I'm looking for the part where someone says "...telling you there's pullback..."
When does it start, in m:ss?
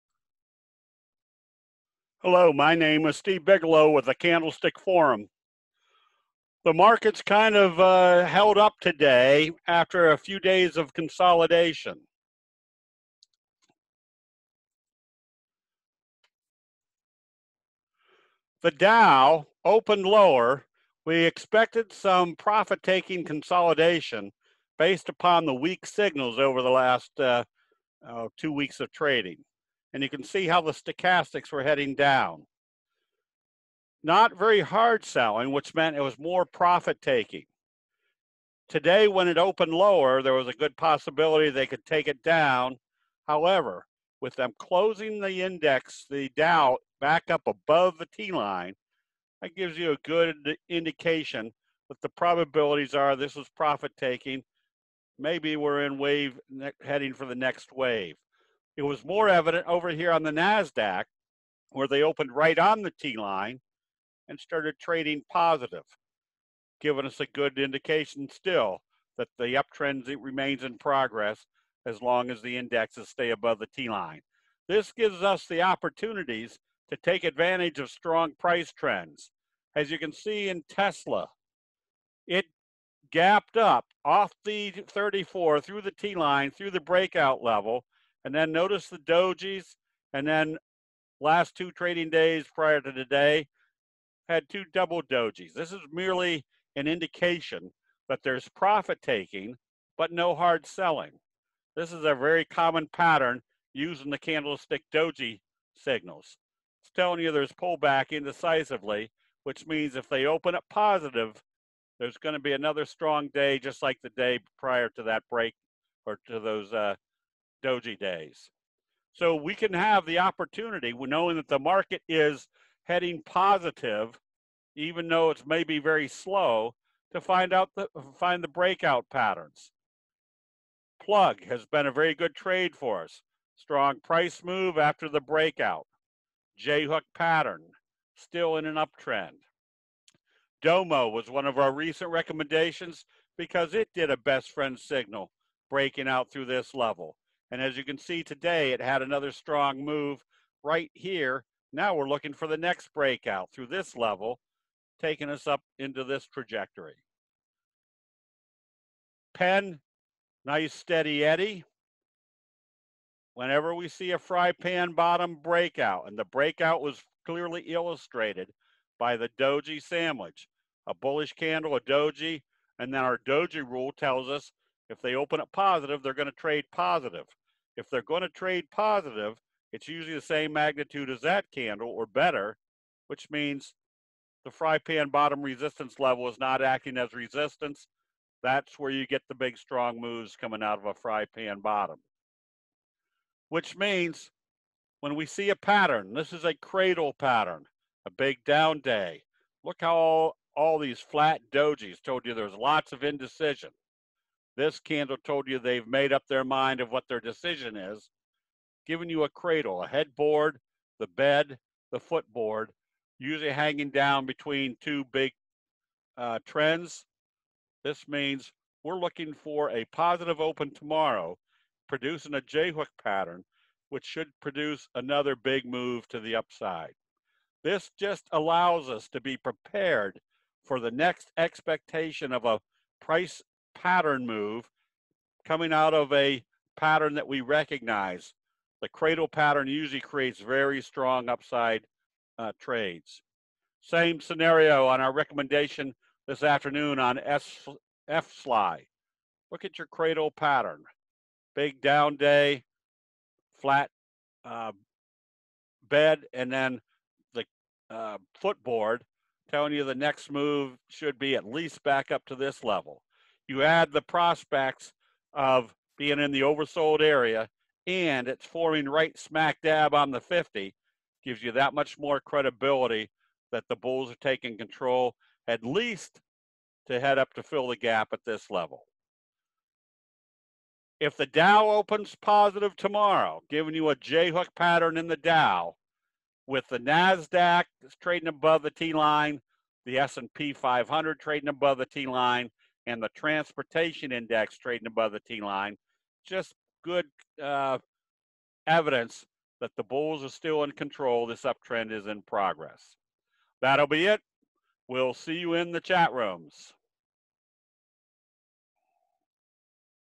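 1:46.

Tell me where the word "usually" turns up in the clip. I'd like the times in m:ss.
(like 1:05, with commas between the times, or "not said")
2:59, 3:33, 3:59.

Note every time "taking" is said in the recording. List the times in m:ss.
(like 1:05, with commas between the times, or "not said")
0:22, 0:37, 0:53, 1:39, 2:35, 4:34.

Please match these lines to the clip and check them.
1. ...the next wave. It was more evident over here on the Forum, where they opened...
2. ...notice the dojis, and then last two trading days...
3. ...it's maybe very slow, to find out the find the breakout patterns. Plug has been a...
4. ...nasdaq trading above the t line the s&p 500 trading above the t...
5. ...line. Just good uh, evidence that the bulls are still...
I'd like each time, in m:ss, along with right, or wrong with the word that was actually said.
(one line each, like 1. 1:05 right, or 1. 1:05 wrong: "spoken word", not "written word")
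1. 0:57 wrong: "NASDAQ", not "Forum"
2. 1:28 right
3. 2:05 right
4. 4:46 right
5. 4:55 right.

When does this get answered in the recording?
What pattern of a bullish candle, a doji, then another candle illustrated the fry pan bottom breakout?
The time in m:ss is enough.
2:49.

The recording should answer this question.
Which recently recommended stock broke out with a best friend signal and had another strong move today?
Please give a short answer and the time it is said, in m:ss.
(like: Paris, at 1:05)
Domo, at 2:20.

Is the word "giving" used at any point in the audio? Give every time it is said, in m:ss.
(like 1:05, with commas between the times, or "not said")
1:06, 3:28, 4:43.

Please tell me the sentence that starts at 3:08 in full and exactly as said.
That's where you get the big strong moves coming out of a fry pan bottom.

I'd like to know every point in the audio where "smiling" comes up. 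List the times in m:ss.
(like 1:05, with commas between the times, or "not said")
not said.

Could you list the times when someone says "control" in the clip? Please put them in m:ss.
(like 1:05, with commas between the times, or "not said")
4:34, 5:00.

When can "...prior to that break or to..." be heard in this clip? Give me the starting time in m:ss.
1:54.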